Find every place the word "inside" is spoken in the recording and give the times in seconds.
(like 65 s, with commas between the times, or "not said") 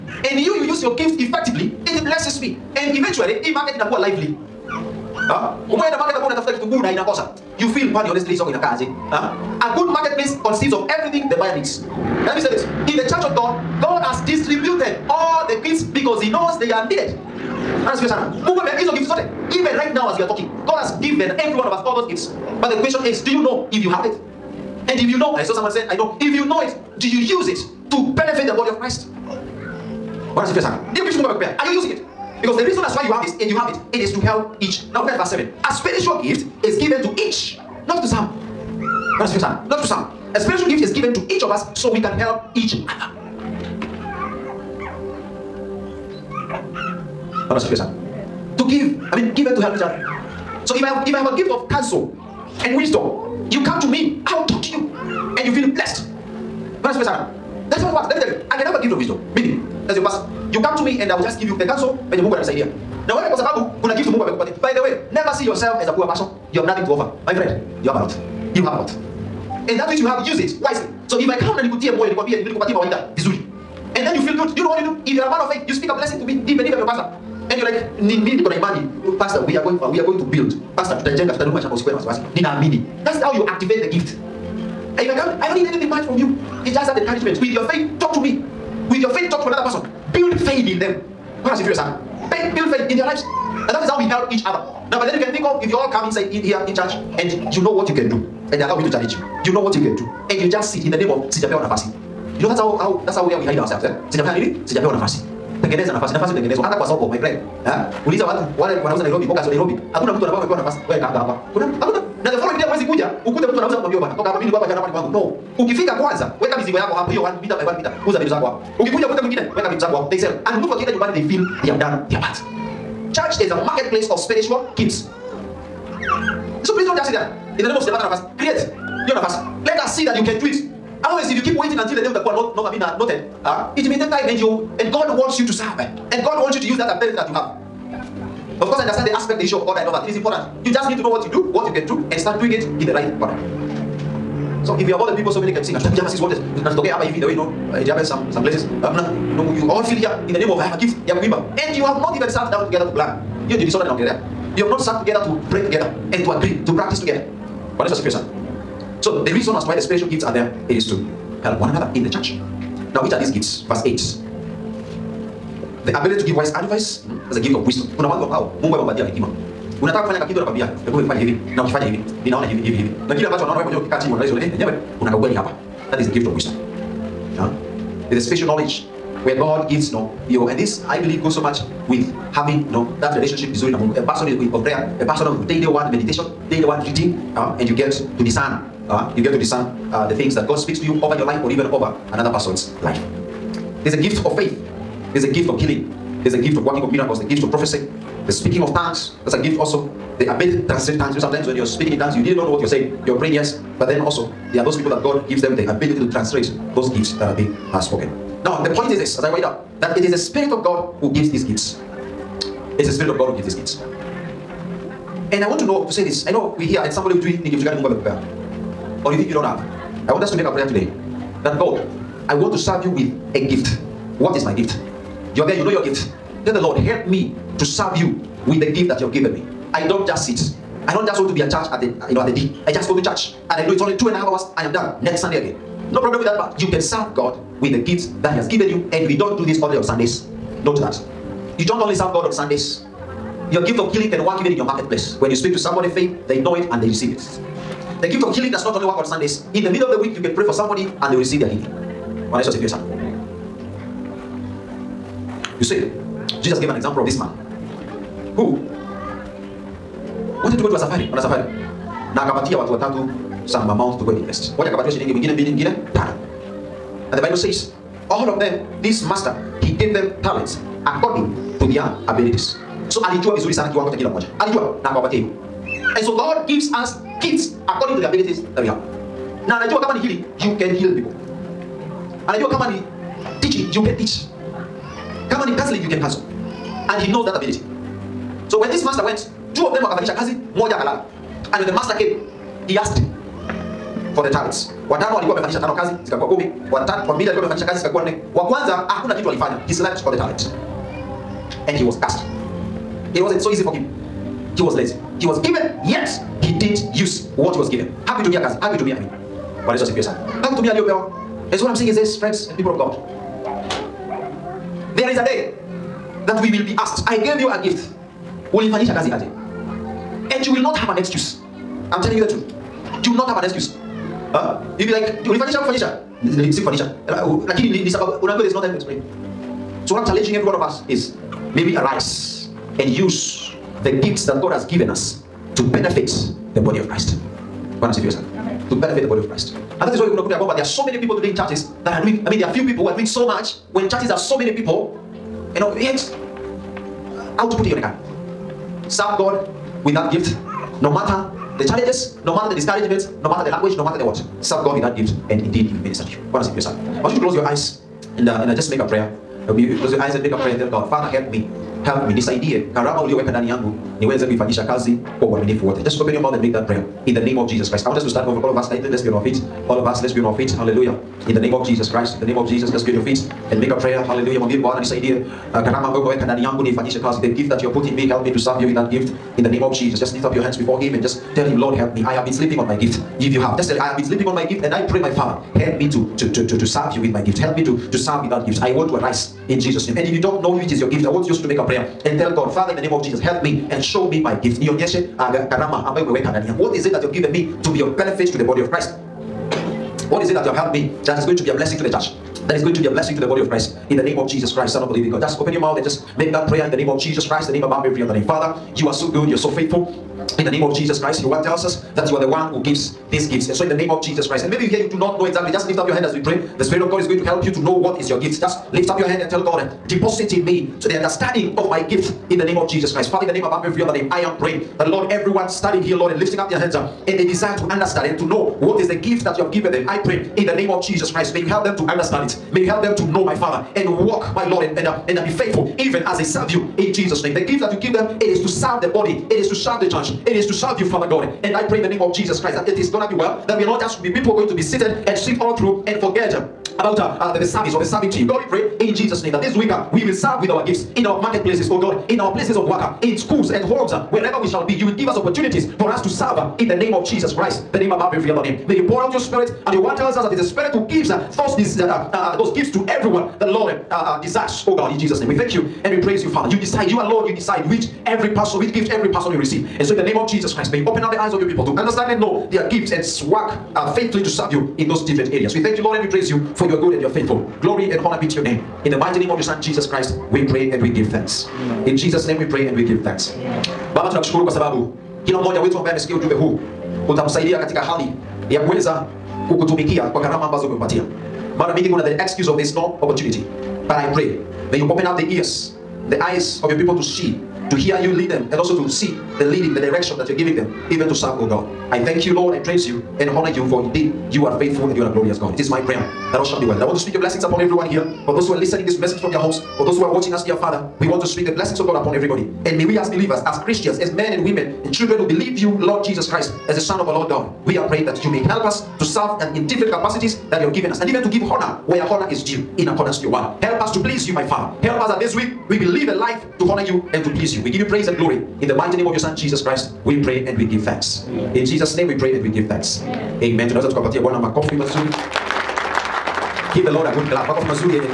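96 s.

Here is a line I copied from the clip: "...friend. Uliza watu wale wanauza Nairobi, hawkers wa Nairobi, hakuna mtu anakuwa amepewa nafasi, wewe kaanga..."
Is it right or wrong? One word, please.
right.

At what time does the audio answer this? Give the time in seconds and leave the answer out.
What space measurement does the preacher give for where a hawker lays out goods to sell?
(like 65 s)
117 s.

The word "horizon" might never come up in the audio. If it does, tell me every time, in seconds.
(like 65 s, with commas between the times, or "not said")
not said.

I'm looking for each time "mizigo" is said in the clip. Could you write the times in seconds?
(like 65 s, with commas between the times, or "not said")
116 s.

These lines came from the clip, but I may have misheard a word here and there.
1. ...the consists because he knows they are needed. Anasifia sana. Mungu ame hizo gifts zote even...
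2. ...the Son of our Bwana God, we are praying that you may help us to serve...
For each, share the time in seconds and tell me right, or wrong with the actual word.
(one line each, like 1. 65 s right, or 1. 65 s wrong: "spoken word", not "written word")
1. 15 s wrong: "gifts", not "consists"
2. 516 s wrong: "Lord", not "Bwana".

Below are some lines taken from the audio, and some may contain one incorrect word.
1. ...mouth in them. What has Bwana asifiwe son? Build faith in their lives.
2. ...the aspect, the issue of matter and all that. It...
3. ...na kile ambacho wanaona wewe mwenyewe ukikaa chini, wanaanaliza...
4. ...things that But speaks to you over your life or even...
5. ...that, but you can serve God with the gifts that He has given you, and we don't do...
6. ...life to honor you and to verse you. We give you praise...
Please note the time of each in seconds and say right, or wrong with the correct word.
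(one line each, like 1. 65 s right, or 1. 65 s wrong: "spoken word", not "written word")
1. 90 s wrong: "faith", not "mouth"
2. 139 s wrong: "order", not "matter"
3. 173 s right
4. 190 s wrong: "God", not "But"
5. 236 s right
6. 526 s wrong: "please", not "verse".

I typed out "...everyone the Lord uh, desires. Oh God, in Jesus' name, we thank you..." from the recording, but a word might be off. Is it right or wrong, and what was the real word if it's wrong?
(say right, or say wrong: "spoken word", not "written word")
right.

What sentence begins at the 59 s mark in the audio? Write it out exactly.
Maybe, as your pastor, you come to me and I will just give you the counsel venye Mungu ananisaidia.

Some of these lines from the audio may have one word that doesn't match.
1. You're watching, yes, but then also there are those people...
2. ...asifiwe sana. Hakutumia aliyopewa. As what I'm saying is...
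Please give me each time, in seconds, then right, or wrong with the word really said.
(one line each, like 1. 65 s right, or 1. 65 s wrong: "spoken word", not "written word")
1. 203 s wrong: "praying", not "watching"
2. 309 s right.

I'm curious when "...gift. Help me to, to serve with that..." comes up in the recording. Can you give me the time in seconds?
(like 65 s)
387 s.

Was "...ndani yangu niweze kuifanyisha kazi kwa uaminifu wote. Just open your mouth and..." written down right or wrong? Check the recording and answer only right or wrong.
right.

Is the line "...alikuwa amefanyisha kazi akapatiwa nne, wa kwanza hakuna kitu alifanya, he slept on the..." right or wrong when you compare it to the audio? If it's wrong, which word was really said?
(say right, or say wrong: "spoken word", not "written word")
wrong: "zikakuwa", not "akapatiwa".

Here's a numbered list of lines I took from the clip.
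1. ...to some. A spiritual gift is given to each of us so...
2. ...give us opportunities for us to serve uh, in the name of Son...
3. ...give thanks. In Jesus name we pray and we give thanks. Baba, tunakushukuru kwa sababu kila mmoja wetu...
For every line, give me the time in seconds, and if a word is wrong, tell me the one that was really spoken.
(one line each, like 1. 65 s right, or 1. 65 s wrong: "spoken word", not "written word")
1. 39 s right
2. 454 s wrong: "Jesus", not "Son"
3. 480 s right.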